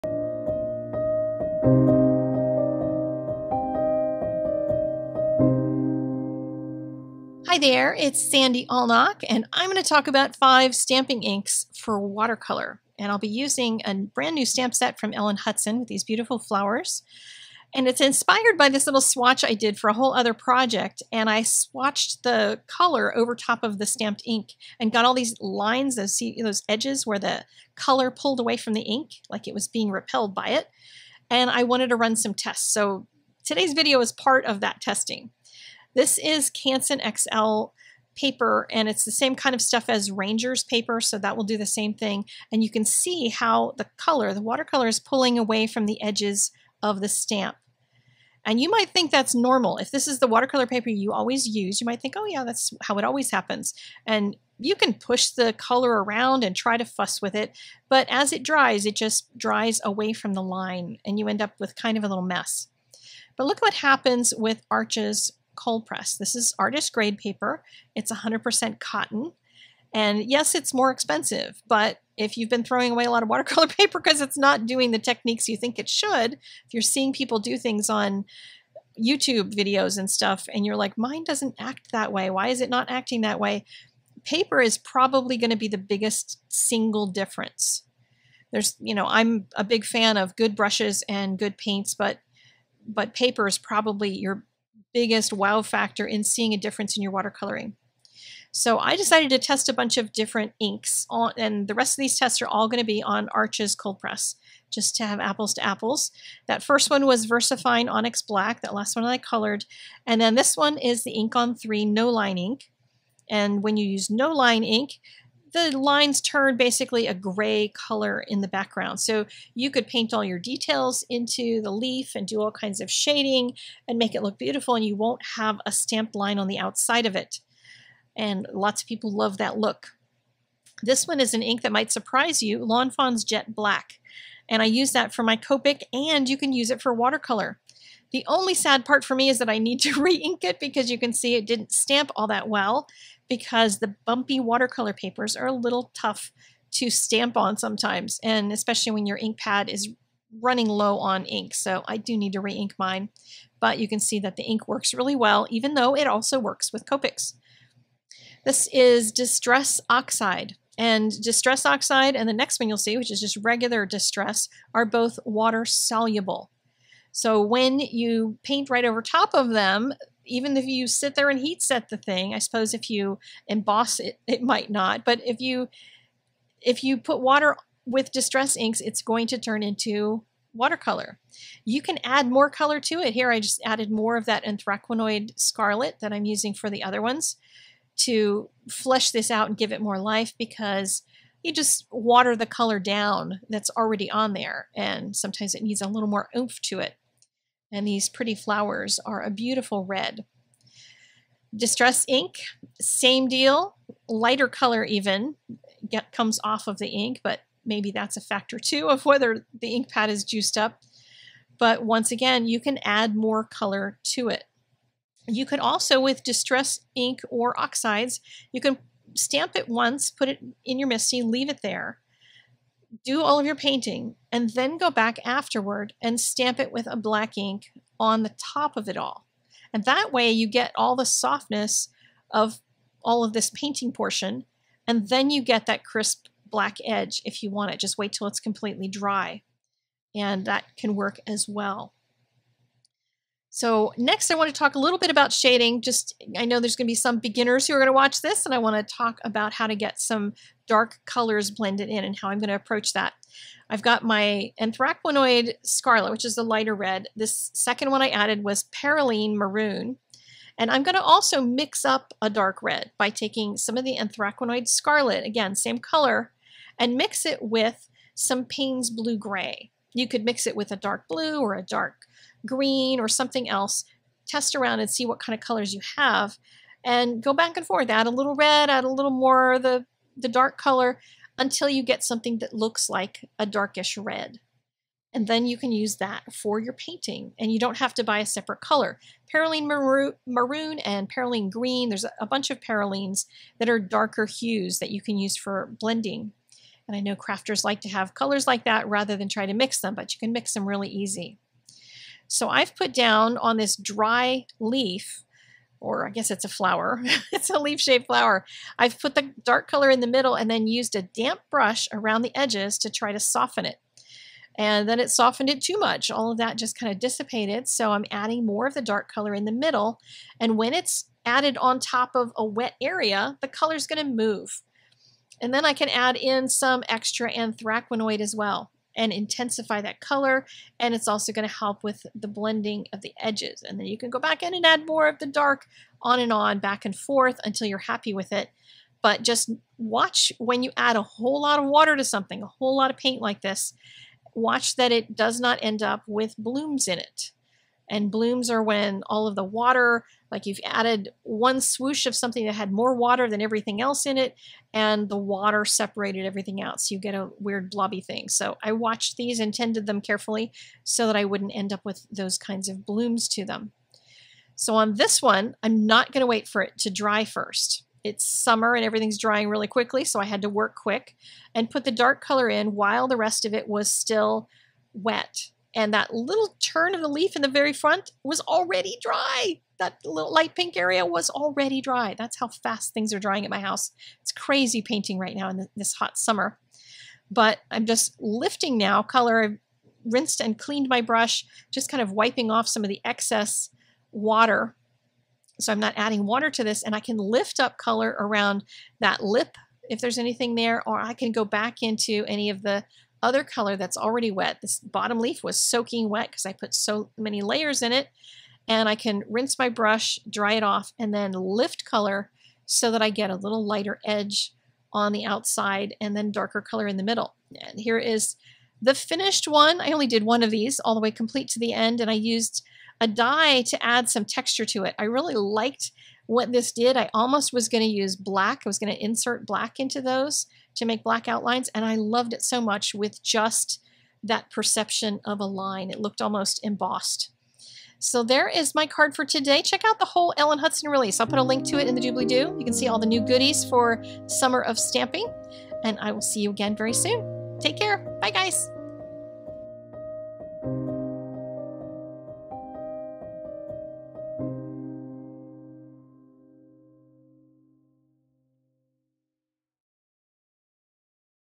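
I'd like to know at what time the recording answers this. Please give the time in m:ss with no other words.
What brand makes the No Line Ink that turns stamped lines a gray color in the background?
1:51.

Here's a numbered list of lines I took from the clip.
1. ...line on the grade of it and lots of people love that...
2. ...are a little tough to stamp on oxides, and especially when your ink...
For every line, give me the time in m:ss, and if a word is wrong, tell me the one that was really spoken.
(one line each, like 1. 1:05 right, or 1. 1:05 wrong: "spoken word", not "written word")
1. 2:06 wrong: "outside", not "grade"
2. 2:25 wrong: "sometimes", not "oxides".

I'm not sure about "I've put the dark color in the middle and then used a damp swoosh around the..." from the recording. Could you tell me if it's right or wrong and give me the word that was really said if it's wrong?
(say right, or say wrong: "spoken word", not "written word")
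wrong: "brush", not "swoosh".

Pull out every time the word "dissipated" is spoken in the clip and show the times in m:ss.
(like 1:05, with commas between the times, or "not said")
5:16.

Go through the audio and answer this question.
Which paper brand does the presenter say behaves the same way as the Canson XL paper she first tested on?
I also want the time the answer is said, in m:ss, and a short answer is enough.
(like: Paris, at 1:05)
Ranger, at 0:40.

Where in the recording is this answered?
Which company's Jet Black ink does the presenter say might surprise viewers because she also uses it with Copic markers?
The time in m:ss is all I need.
2:12.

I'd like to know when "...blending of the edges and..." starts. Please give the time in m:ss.
5:32.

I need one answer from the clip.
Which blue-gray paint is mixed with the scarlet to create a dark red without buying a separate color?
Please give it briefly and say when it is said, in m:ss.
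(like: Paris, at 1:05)
Payne's Blue Gray, at 4:28.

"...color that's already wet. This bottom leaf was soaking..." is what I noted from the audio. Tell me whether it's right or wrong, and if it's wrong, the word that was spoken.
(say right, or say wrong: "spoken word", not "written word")
right.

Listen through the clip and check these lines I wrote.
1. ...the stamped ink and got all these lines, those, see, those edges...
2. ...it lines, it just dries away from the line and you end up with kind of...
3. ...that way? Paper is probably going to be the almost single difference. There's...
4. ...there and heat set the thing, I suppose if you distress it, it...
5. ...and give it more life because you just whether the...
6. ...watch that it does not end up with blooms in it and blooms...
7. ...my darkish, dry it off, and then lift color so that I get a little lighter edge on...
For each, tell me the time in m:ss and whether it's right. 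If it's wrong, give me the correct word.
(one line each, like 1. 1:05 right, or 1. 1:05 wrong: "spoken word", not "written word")
1. 0:23 right
2. 0:58 wrong: "dries", not "lines"
3. 1:23 wrong: "biggest", not "almost"
4. 2:51 wrong: "emboss", not "distress"
5. 3:09 wrong: "water", not "whether"
6. 5:44 right
7. 6:49 wrong: "brush", not "darkish".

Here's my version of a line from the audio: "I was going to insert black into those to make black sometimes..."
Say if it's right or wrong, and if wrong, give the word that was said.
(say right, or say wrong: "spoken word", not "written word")
wrong: "outlines", not "sometimes".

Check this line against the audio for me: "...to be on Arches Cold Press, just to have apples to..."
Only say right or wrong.
right.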